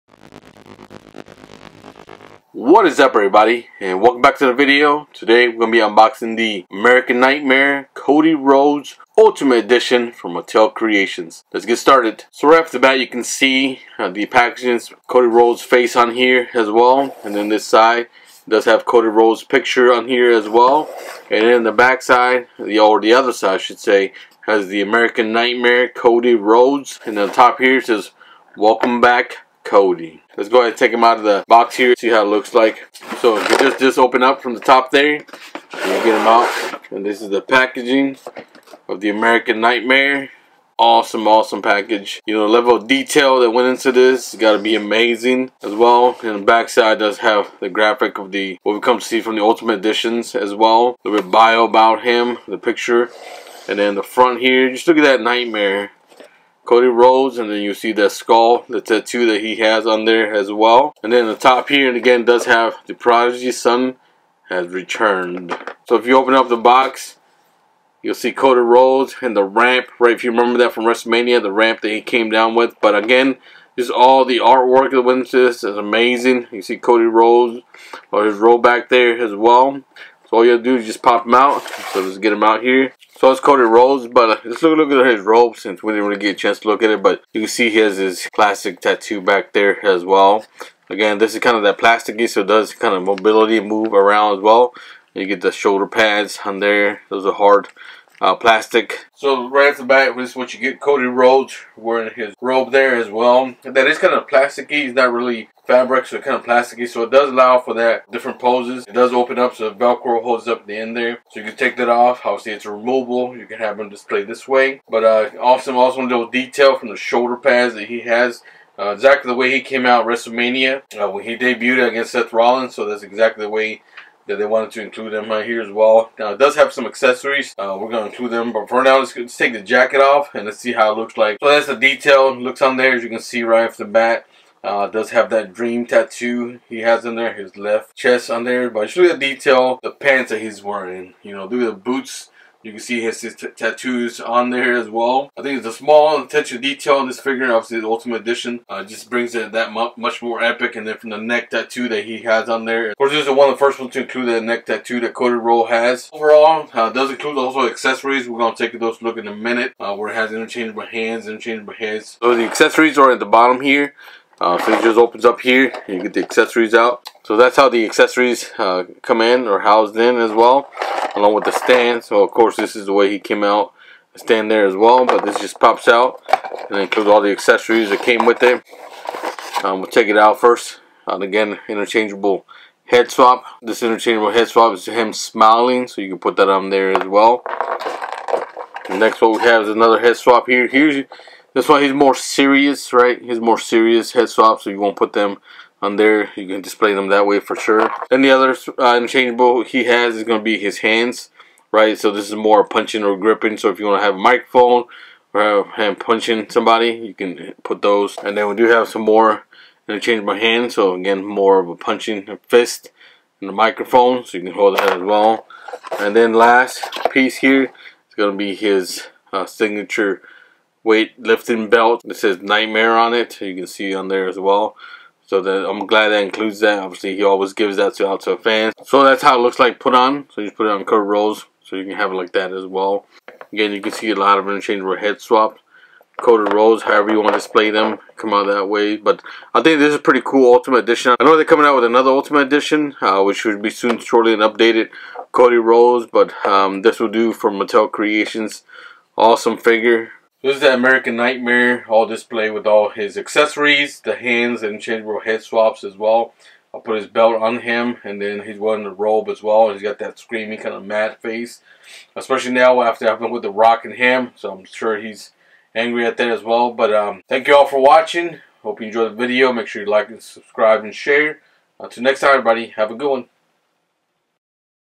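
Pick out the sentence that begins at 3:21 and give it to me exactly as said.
So this is more punching or gripping.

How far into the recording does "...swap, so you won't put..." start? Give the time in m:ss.
3:14.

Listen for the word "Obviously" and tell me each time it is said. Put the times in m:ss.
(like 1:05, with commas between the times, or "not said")
1:52, 2:27, 3:46.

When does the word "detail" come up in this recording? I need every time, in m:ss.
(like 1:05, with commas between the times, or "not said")
0:42, 1:56, 2:11, 2:19, 2:26.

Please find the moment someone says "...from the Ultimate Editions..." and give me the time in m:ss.
0:49.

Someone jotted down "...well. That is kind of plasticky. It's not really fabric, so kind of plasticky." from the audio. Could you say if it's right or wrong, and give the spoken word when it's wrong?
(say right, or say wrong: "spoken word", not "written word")
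right.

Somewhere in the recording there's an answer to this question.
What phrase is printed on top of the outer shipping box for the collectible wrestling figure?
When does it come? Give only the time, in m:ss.
0:28.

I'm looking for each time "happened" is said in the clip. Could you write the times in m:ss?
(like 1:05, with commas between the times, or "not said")
4:23.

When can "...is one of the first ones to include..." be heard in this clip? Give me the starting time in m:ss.
2:33.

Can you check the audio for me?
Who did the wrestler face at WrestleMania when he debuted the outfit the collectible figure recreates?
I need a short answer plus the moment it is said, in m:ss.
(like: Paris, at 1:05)
Seth Rollins, at 2:02.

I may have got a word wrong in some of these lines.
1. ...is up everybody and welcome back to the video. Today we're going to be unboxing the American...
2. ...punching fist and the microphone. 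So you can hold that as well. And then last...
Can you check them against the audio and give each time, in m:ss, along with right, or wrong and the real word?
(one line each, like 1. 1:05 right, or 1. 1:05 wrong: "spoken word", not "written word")
1. 0:02 right
2. 3:31 right.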